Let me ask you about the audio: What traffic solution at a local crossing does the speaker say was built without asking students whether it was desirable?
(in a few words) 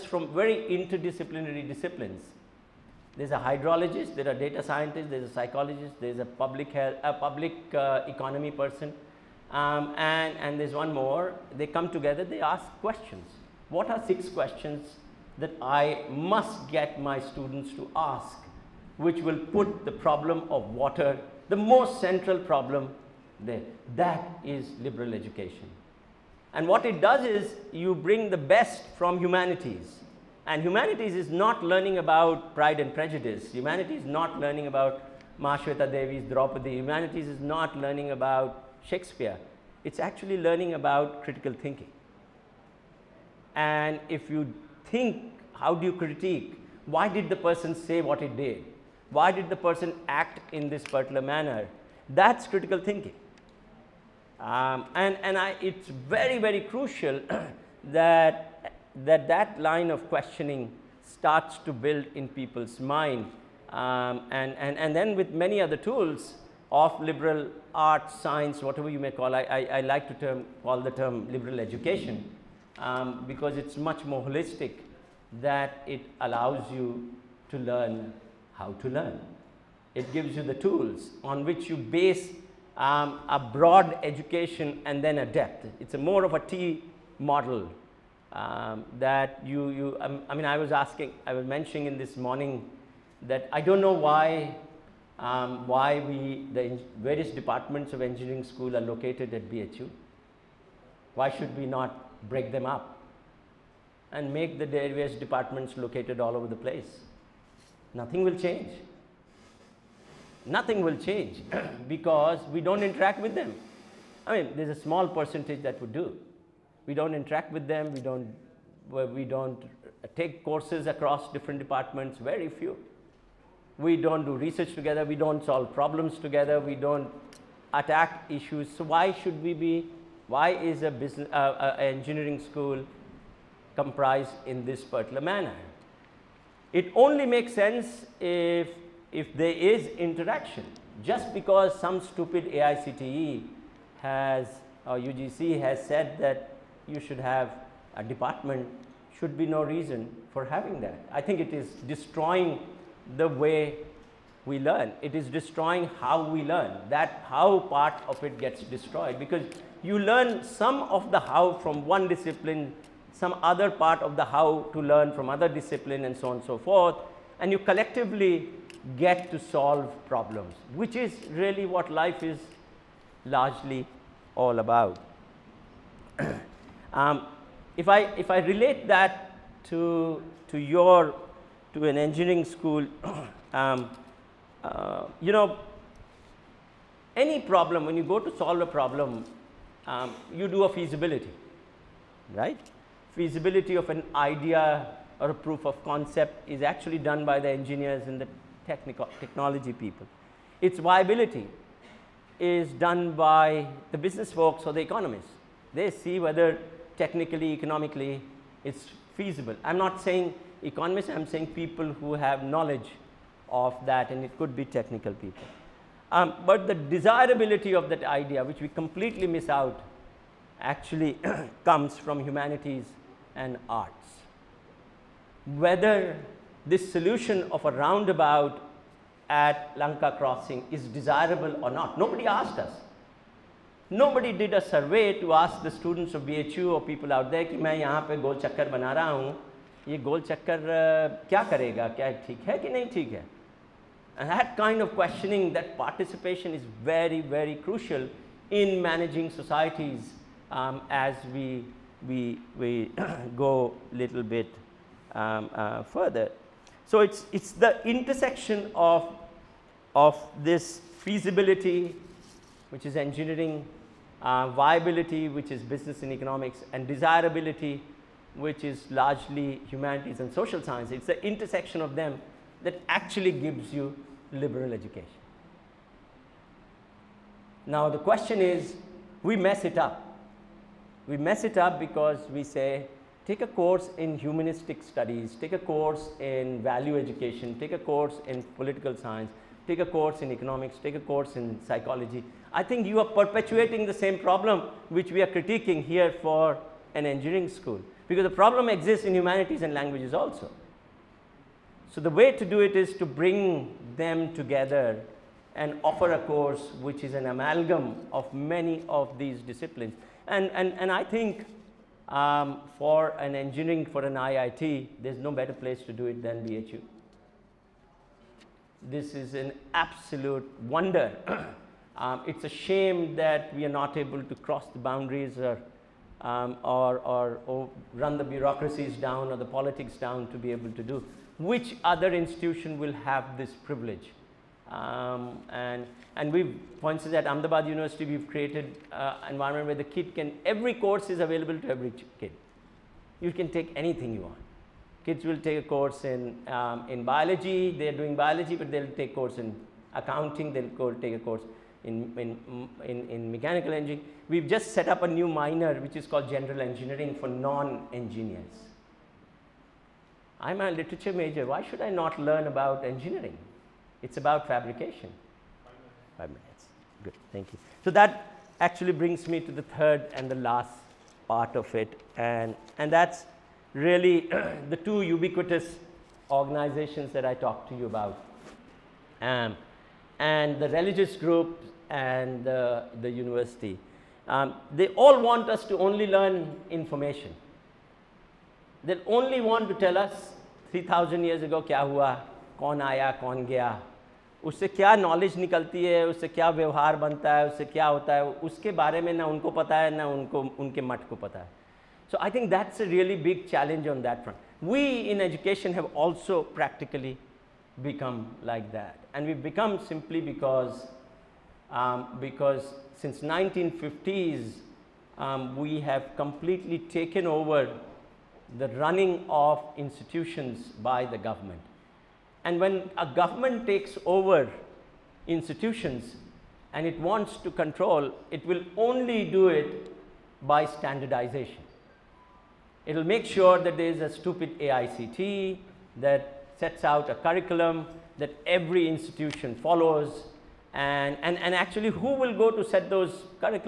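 roundabout.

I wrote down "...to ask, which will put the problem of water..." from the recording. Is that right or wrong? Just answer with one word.
right.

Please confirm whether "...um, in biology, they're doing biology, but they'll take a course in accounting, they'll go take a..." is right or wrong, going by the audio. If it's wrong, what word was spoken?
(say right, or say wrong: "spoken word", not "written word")
right.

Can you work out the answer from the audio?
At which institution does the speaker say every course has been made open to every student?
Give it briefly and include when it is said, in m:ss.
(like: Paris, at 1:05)
Ahmedabad University, at 5:37.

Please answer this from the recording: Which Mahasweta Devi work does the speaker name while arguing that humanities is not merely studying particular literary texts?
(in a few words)
Draupadi.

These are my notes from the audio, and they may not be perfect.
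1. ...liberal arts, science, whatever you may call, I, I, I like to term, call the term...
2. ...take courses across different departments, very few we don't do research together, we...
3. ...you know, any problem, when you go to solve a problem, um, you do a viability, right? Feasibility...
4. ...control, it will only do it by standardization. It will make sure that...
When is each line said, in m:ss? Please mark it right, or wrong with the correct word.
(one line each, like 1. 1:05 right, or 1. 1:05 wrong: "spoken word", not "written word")
1. 1:06 right
2. 2:00 right
3. 3:05 wrong: "feasibility", not "viability"
4. 7:07 right.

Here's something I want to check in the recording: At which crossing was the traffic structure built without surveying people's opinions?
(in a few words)
Lanka crossing.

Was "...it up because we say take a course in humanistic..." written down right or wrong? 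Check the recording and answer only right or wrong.
right.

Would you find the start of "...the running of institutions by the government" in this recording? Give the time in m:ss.
6:58.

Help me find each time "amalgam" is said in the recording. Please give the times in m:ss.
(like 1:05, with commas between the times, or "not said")
5:07.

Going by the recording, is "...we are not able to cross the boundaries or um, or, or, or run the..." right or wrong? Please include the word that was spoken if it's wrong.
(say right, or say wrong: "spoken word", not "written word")
right.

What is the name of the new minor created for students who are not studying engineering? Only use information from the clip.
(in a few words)
general engineering.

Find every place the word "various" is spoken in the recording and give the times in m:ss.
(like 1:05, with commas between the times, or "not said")
1:37, 1:44.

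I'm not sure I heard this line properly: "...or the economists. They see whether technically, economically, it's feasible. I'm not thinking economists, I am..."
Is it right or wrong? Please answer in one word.
wrong.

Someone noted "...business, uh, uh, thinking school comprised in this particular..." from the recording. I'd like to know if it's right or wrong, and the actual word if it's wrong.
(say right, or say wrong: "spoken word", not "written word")
wrong: "engineering", not "thinking".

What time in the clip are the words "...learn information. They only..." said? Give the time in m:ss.
6:26.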